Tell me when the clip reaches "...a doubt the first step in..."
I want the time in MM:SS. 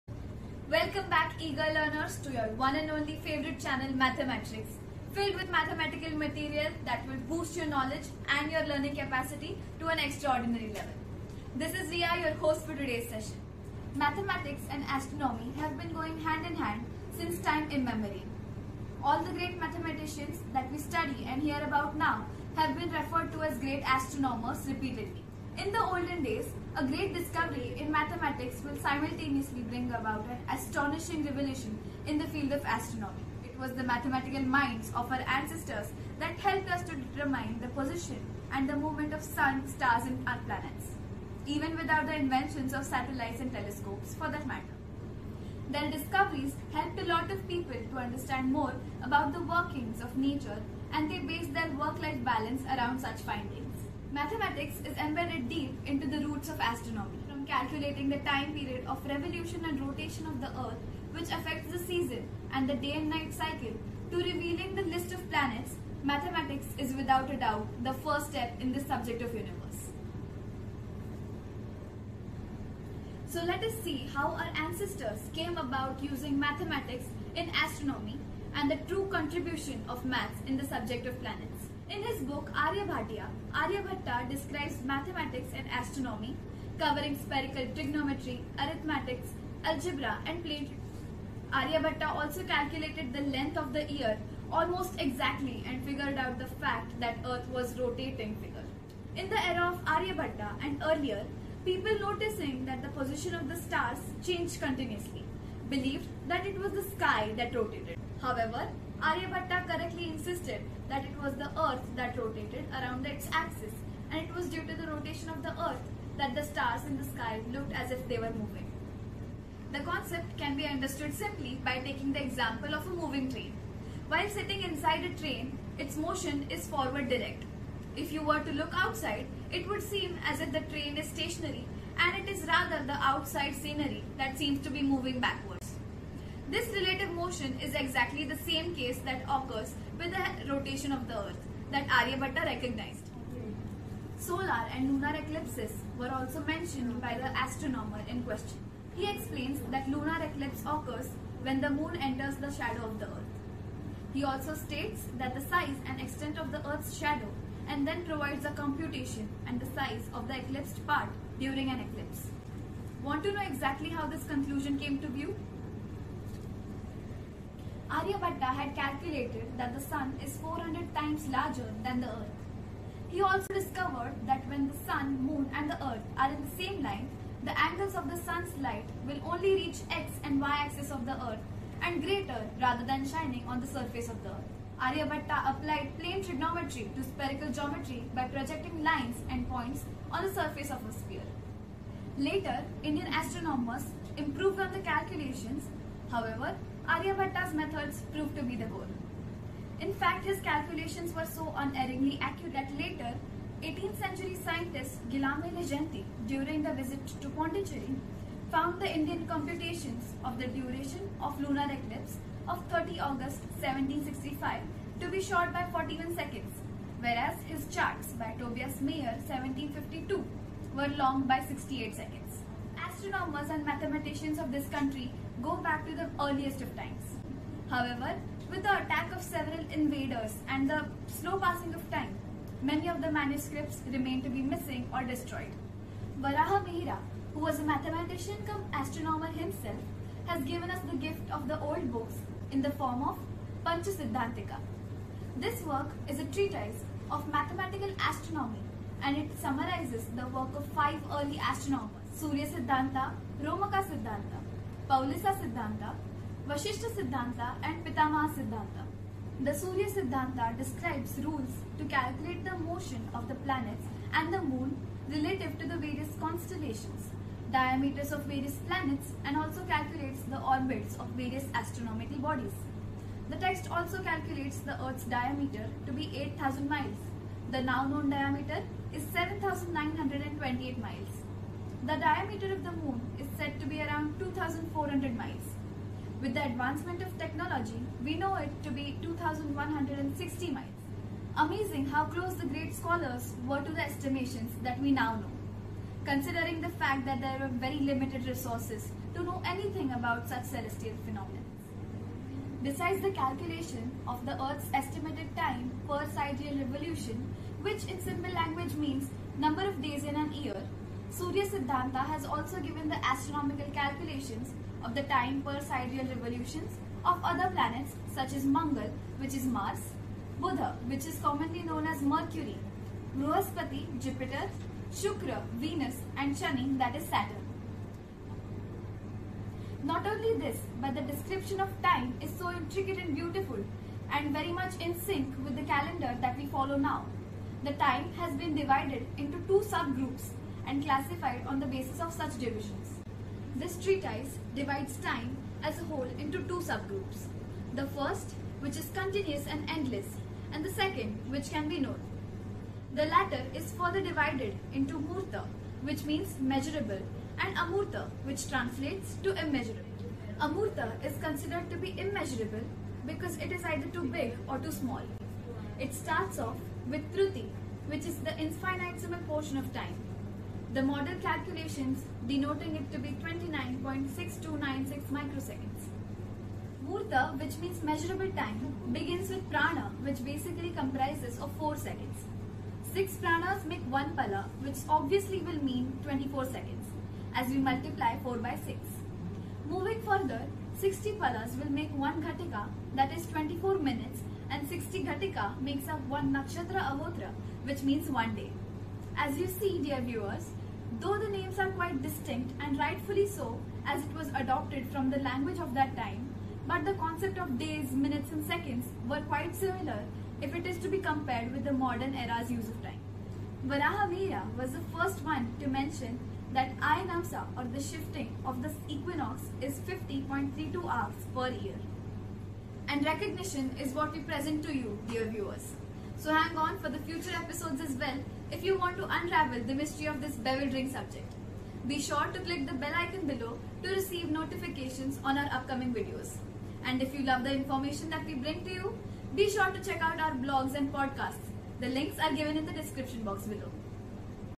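01:07.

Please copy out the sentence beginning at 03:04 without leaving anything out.
Aryabhatta applied plane trigonometry to spherical geometry by projecting lines and points on the surface of a sphere.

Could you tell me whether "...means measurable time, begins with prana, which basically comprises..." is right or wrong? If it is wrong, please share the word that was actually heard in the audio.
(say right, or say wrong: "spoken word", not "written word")
right.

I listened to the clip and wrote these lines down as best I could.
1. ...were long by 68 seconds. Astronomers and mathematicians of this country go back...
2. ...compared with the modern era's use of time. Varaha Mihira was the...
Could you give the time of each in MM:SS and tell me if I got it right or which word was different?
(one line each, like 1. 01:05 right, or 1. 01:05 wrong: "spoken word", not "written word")
1. 03:40 right
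2. 06:50 right.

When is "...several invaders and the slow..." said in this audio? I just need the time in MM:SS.
03:49.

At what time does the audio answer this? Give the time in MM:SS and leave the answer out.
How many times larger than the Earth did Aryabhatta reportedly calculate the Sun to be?
02:50.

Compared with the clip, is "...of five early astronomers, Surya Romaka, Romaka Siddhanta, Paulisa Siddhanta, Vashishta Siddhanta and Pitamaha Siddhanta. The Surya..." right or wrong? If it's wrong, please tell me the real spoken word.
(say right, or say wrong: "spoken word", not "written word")
wrong: "Siddhanta", not "Romaka".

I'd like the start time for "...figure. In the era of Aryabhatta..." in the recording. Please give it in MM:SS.
01:38.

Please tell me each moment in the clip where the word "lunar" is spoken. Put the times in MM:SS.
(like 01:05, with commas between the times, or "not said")
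02:24, 02:29, 03:31.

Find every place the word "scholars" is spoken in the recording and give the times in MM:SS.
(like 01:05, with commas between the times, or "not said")
04:52.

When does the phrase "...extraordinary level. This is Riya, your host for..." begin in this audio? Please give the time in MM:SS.
00:09.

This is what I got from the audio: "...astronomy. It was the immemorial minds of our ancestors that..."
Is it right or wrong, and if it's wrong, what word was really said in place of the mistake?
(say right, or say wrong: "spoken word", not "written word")
wrong: "mathematical", not "immemorial".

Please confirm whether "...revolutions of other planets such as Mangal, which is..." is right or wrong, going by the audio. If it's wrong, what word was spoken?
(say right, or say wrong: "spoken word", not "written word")
right.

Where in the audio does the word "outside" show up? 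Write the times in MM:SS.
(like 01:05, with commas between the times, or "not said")
02:08, 02:13.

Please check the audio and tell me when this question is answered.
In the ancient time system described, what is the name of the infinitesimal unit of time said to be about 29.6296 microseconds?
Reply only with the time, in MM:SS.
06:07.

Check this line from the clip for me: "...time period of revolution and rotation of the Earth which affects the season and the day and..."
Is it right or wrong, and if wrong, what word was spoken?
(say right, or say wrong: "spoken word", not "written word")
right.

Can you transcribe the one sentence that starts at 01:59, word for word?
The concept can be understood simply by taking the example of a moving train.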